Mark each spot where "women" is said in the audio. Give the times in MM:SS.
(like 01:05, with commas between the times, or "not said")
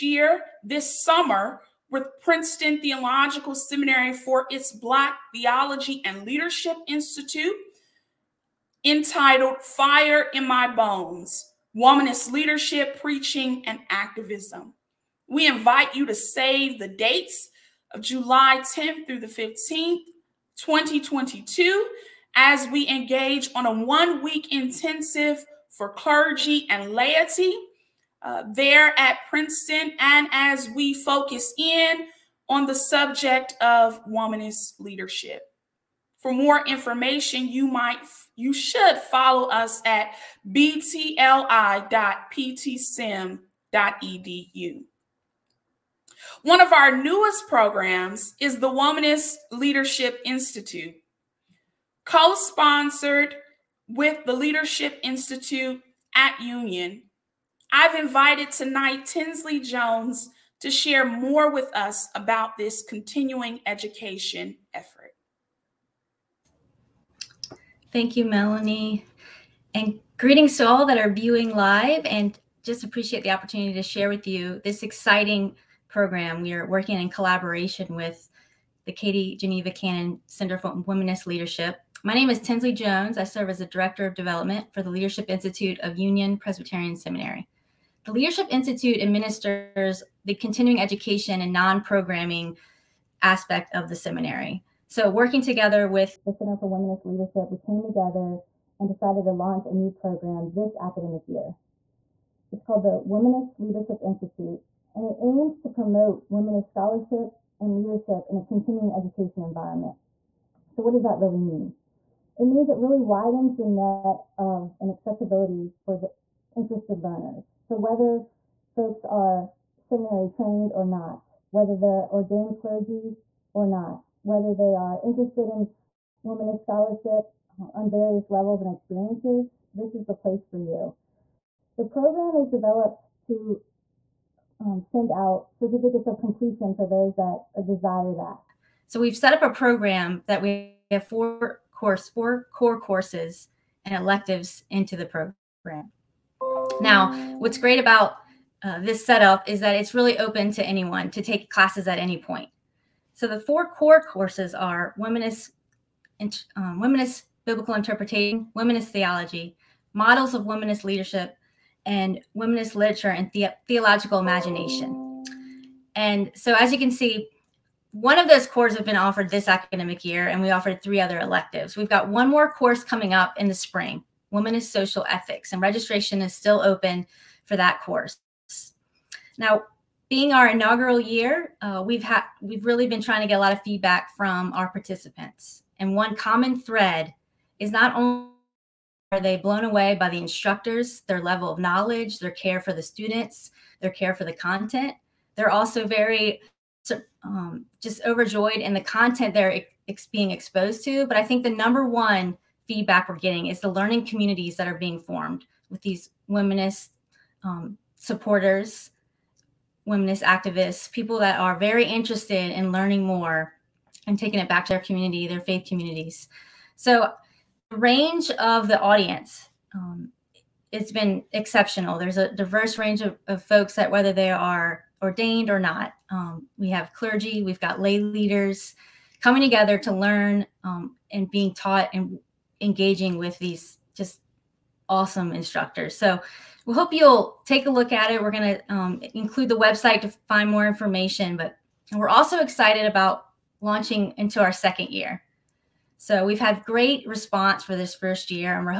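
01:46, 02:06.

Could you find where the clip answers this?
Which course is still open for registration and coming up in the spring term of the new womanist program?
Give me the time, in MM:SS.
02:54.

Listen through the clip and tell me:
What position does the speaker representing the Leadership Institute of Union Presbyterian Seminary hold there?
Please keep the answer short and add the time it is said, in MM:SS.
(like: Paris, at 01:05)
Director of Development, at 01:23.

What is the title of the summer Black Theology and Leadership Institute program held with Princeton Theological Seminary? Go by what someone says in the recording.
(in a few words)
Fire in My Bones.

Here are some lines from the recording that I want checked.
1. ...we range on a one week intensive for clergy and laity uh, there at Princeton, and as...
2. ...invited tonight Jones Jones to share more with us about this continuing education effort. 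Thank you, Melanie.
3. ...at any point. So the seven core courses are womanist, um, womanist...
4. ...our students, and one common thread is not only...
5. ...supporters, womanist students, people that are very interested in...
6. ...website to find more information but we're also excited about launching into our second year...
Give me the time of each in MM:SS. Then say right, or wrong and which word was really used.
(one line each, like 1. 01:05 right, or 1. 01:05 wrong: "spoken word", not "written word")
1. 00:22 wrong: "engage", not "range"
2. 00:57 wrong: "Tinsley", not "Jones"
3. 02:31 wrong: "four", not "seven"
4. 03:04 wrong: "participants", not "students"
5. 03:27 wrong: "activists", not "students"
6. 03:59 right.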